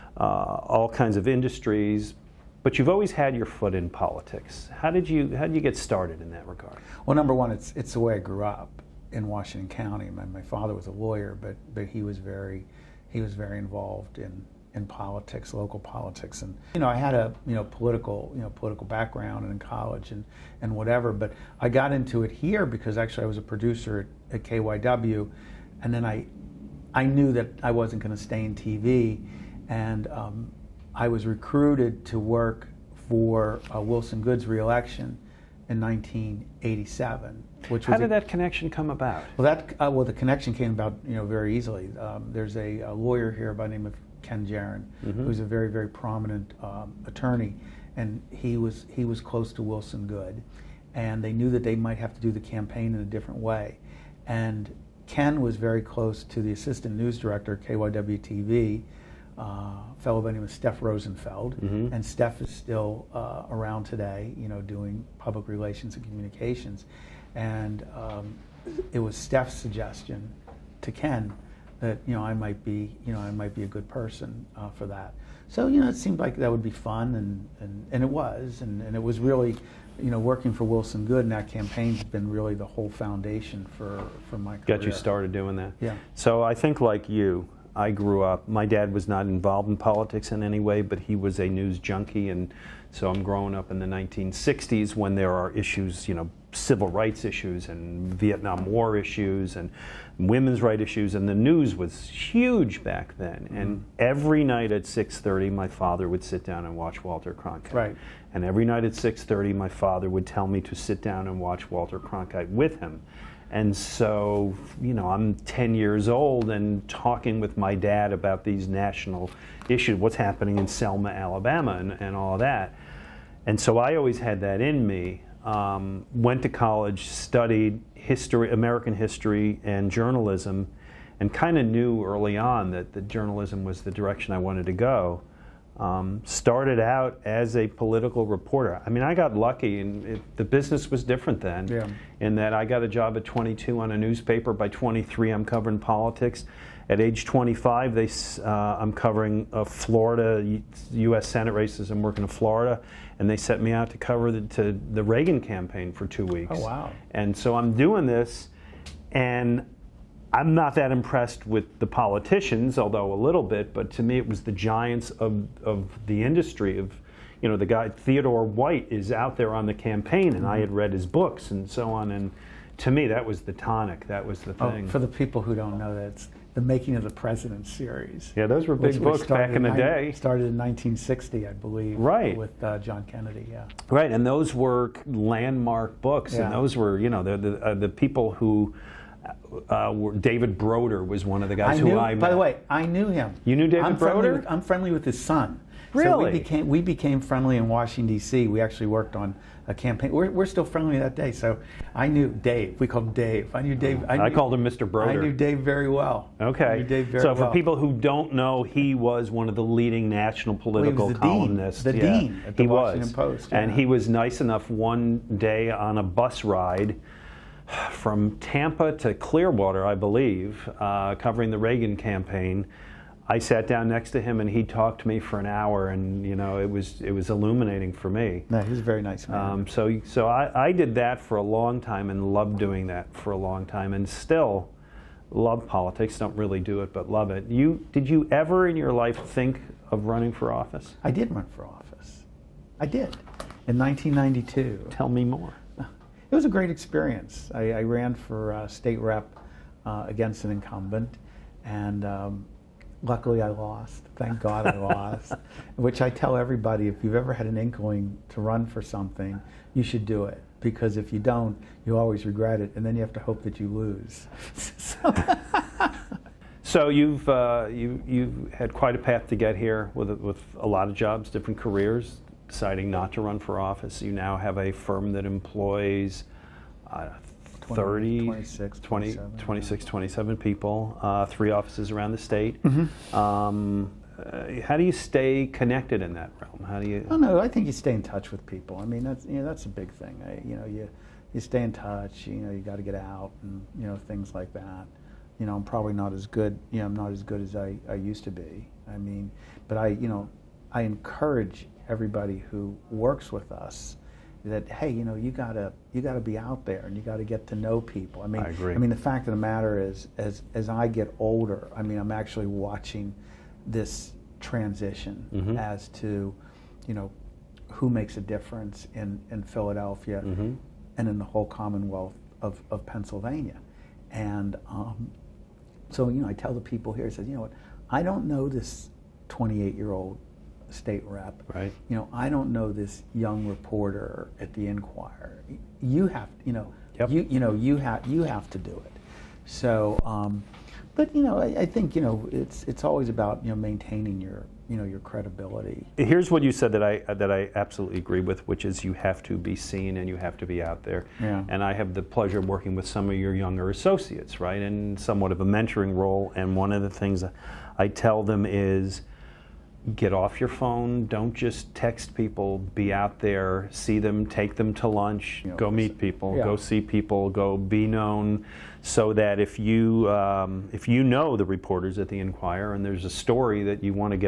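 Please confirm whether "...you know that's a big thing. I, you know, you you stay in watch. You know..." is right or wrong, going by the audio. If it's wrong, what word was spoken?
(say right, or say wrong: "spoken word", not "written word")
wrong: "touch", not "watch".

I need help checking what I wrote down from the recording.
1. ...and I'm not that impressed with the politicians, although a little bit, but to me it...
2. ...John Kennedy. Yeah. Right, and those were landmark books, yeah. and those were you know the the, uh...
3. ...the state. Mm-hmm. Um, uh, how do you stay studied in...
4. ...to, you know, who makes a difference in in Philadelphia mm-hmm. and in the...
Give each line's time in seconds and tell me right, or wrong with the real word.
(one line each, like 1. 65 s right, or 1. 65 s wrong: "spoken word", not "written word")
1. 159 s right
2. 182 s right
3. 282 s wrong: "connected", not "studied"
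4. 315 s right.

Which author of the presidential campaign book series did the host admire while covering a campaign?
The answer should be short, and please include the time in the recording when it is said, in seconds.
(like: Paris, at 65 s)
Theodore White, at 167 s.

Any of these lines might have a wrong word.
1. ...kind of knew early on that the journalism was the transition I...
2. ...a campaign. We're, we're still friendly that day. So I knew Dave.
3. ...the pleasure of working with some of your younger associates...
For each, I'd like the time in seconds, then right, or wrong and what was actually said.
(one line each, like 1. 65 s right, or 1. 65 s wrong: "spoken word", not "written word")
1. 131 s wrong: "direction", not "transition"
2. 199 s right
3. 351 s right.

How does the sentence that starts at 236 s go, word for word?
Don't really do it, but love it.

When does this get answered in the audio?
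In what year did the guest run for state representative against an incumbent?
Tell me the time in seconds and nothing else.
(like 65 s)
243 s.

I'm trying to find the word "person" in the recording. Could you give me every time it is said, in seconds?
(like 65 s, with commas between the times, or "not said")
73 s.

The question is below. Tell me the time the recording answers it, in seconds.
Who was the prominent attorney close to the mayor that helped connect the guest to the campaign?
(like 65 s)
44 s.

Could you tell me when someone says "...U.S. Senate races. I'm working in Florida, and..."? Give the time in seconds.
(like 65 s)
151 s.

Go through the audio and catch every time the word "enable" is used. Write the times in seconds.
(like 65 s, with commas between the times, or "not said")
not said.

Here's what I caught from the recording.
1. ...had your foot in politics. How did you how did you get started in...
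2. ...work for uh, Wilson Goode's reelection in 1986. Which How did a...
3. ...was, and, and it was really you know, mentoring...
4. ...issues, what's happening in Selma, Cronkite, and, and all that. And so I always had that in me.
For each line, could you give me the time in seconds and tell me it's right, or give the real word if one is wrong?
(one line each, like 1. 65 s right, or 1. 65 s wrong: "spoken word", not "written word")
1. 3 s right
2. 32 s wrong: "1987", not "1986"
3. 78 s wrong: "working", not "mentoring"
4. 119 s wrong: "Alabama", not "Cronkite".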